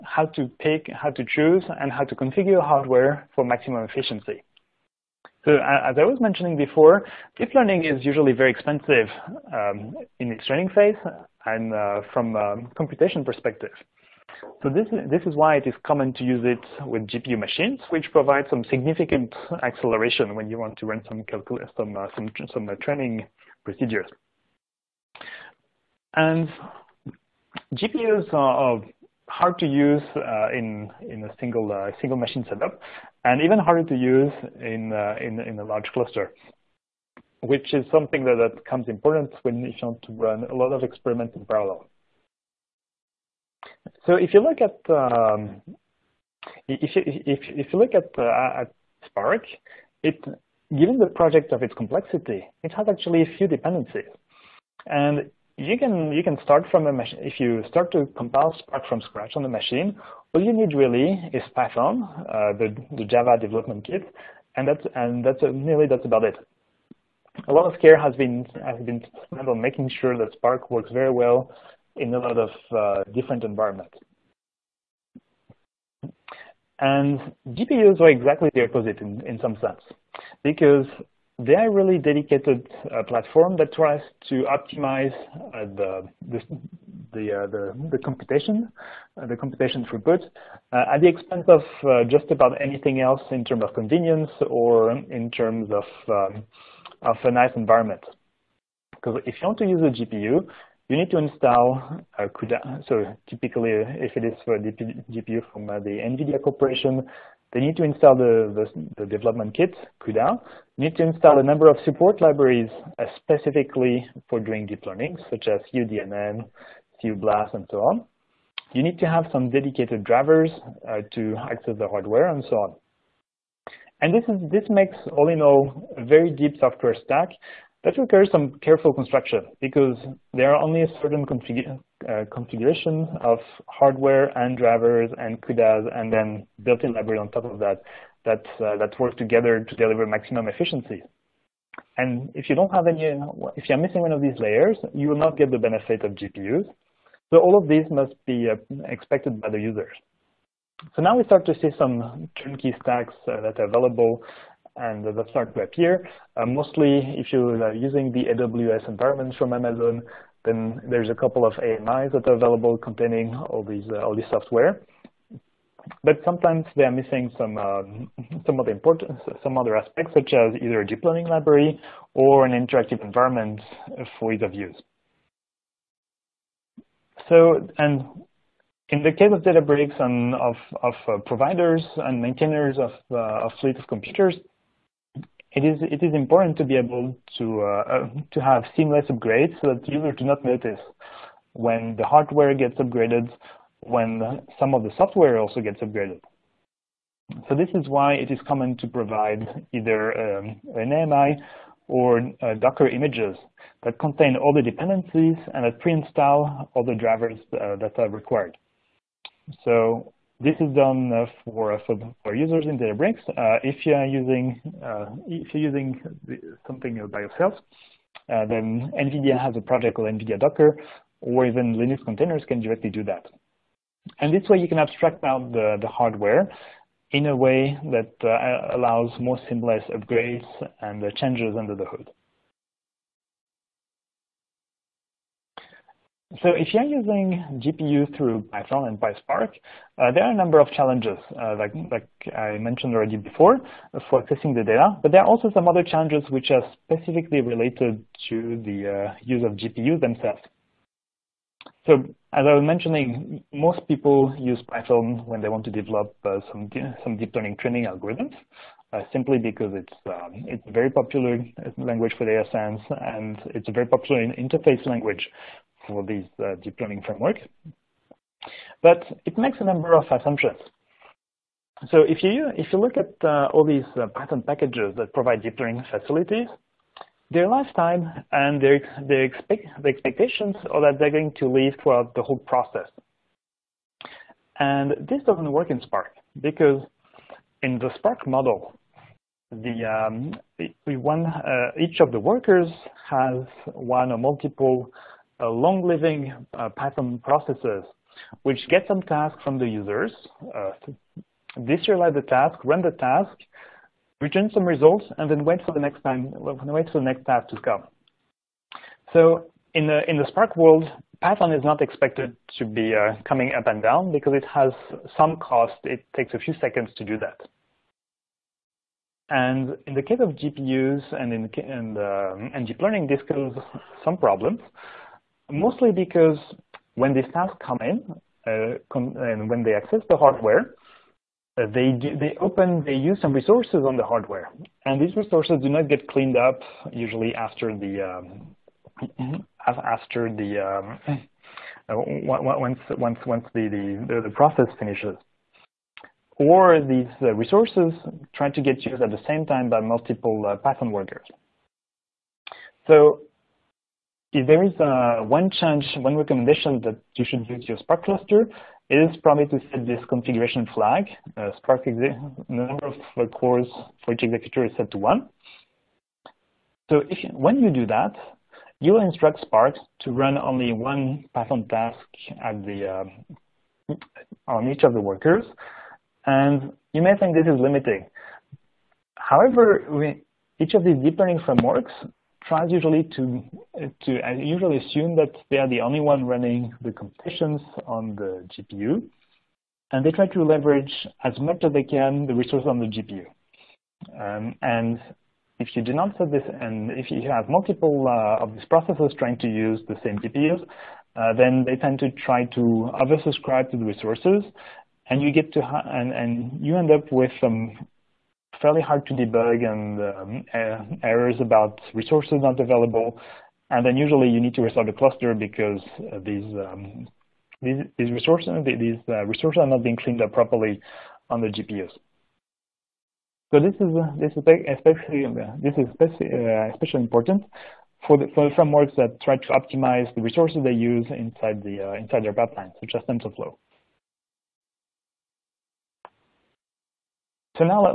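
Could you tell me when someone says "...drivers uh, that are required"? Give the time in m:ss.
3:26.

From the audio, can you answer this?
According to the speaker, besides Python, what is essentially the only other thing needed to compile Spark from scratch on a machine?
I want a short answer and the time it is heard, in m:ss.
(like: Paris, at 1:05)
Java development kit, at 1:02.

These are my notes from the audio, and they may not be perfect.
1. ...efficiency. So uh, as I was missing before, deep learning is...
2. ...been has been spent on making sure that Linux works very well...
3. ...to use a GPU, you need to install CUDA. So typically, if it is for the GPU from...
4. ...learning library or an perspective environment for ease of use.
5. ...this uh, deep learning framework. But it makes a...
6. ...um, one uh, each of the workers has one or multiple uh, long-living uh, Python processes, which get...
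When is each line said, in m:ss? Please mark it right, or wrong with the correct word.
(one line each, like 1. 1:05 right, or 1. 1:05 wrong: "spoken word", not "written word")
1. 0:03 wrong: "mentioning", not "missing"
2. 1:08 wrong: "Spark", not "Linux"
3. 1:39 right
4. 2:51 wrong: "interactive", not "perspective"
5. 4:26 right
6. 4:50 right.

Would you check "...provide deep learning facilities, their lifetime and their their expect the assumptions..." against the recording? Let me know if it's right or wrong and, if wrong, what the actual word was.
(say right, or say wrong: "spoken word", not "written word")
wrong: "expectations", not "assumptions".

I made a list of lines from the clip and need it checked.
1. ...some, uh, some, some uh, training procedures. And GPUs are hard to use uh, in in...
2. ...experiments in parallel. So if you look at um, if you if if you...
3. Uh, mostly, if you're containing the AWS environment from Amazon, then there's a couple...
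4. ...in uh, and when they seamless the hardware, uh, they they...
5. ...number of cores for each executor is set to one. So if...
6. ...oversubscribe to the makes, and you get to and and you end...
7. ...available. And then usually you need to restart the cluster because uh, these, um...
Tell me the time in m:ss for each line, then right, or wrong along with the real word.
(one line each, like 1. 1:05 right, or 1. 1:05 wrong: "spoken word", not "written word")
1. 0:21 right
2. 0:40 right
3. 2:36 wrong: "using", not "containing"
4. 5:27 wrong: "access", not "seamless"
5. 6:02 right
6. 6:43 wrong: "resources", not "makes"
7. 6:52 right.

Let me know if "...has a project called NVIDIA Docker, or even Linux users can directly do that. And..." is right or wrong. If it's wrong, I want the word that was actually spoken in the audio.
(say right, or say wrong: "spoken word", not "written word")
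wrong: "containers", not "users".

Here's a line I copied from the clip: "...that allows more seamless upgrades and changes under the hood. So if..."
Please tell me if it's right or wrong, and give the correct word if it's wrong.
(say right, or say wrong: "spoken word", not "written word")
right.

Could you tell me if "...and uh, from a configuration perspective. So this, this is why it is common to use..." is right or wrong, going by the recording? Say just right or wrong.
wrong.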